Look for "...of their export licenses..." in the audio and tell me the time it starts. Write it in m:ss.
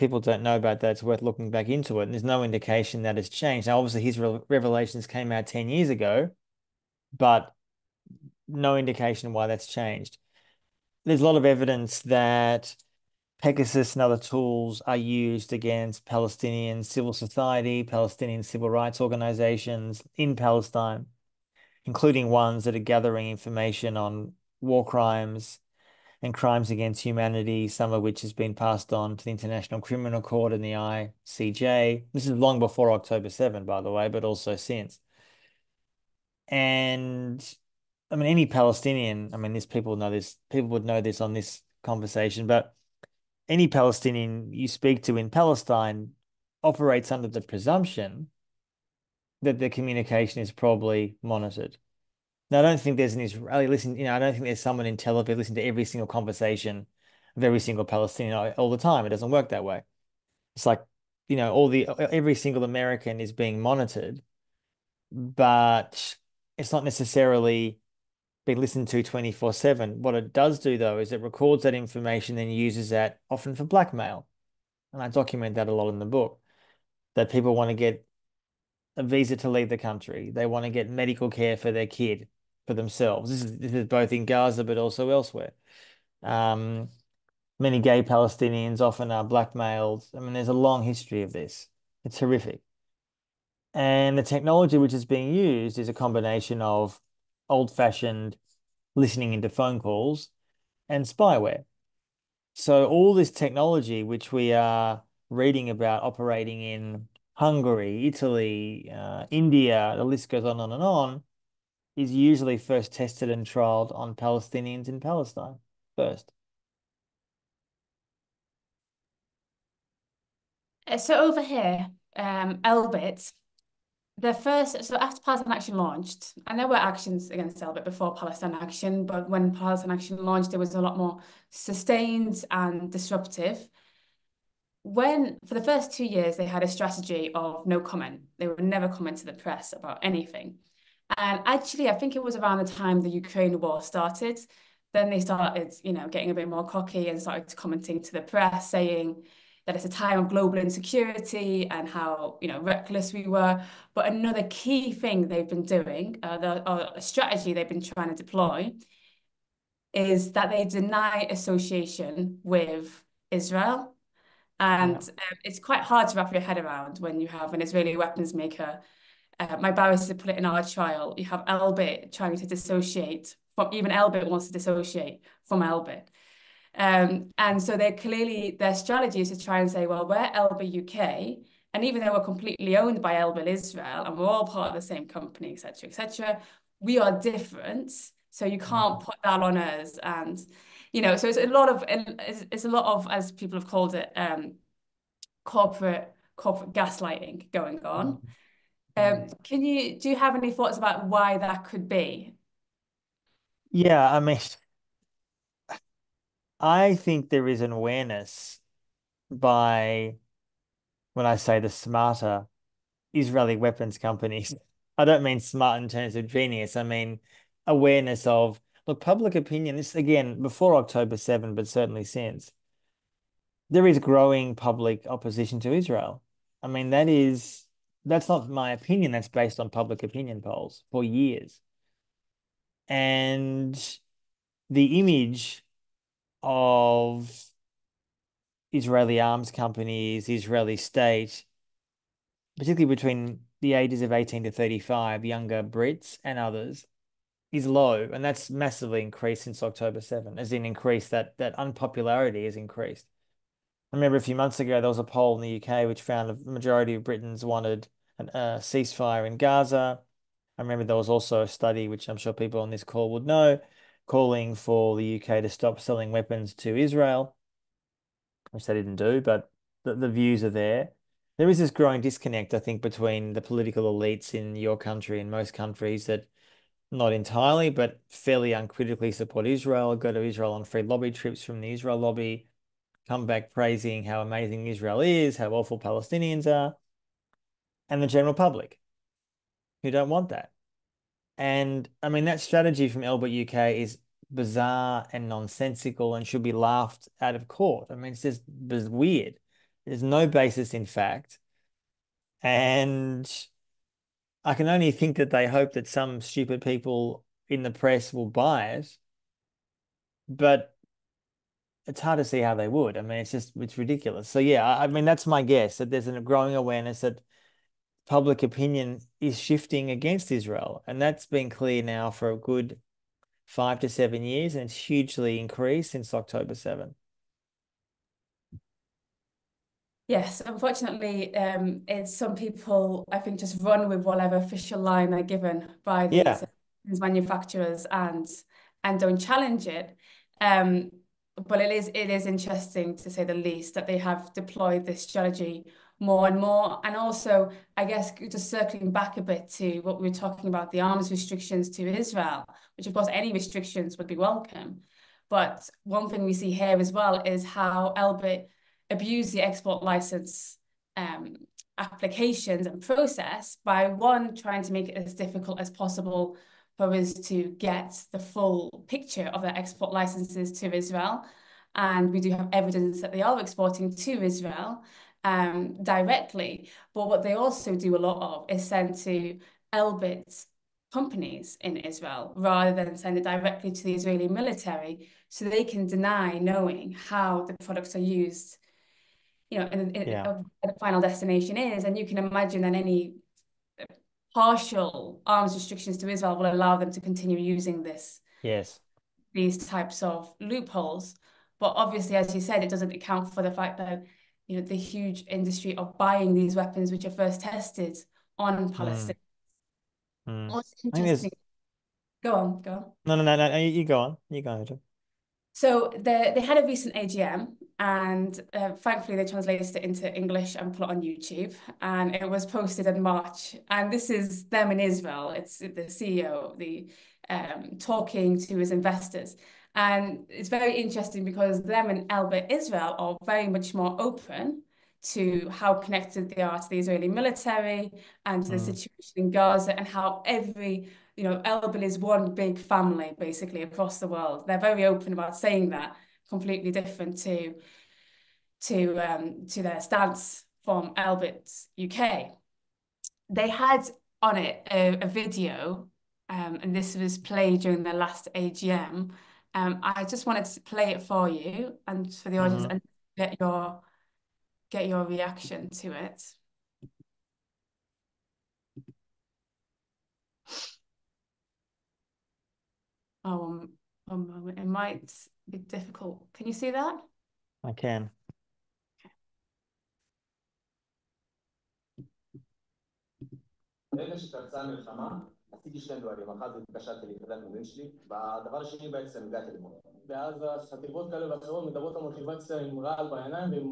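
6:09.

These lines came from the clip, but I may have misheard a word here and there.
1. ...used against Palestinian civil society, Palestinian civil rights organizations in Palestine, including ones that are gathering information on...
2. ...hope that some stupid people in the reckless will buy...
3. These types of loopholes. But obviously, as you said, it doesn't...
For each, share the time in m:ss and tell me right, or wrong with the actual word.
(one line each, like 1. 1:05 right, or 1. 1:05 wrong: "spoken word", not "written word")
1. 0:14 right
2. 5:05 wrong: "press", not "reckless"
3. 6:39 right.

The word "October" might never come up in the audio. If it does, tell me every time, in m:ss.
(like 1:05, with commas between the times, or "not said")
0:32, 3:40, 4:09, 5:26.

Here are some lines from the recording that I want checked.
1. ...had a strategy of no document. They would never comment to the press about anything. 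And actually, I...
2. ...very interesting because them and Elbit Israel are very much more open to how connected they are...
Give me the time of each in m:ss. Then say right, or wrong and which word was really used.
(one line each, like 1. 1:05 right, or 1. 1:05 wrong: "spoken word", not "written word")
1. 2:16 wrong: "comment", not "document"
2. 7:10 right.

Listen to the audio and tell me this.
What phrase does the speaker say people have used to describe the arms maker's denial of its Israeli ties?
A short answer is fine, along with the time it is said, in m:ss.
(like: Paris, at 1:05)
Corporate gaslighting, at 3:16.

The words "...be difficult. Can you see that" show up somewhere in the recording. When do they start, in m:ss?
7:55.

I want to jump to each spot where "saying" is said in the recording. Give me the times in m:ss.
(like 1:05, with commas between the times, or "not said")
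2:28, 7:25.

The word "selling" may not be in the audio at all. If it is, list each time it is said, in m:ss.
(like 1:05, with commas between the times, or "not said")
4:25.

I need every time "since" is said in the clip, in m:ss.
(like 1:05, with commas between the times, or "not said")
0:34, 3:42, 4:09, 5:25.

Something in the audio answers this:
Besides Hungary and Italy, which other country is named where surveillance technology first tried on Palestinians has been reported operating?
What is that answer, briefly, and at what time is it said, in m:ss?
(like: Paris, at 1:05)
India, at 1:49.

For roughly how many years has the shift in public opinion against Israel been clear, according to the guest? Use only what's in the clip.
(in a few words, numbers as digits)
5 to 7 years.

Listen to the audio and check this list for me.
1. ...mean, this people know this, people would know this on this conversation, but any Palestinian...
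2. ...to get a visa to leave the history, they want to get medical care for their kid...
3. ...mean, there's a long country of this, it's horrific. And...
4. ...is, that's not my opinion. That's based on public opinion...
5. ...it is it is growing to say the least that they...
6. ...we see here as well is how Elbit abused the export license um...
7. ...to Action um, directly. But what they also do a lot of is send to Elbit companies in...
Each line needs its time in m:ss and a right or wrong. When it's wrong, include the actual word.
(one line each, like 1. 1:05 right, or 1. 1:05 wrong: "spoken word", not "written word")
1. 0:39 right
2. 1:17 wrong: "country", not "history"
3. 1:30 wrong: "history", not "country"
4. 3:47 right
5. 5:41 wrong: "interesting", not "growing"
6. 5:56 right
7. 6:13 wrong: "Israel", not "Action".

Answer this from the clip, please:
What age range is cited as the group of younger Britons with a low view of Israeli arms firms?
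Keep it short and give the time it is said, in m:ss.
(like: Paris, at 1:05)
18 to 35, at 4:04.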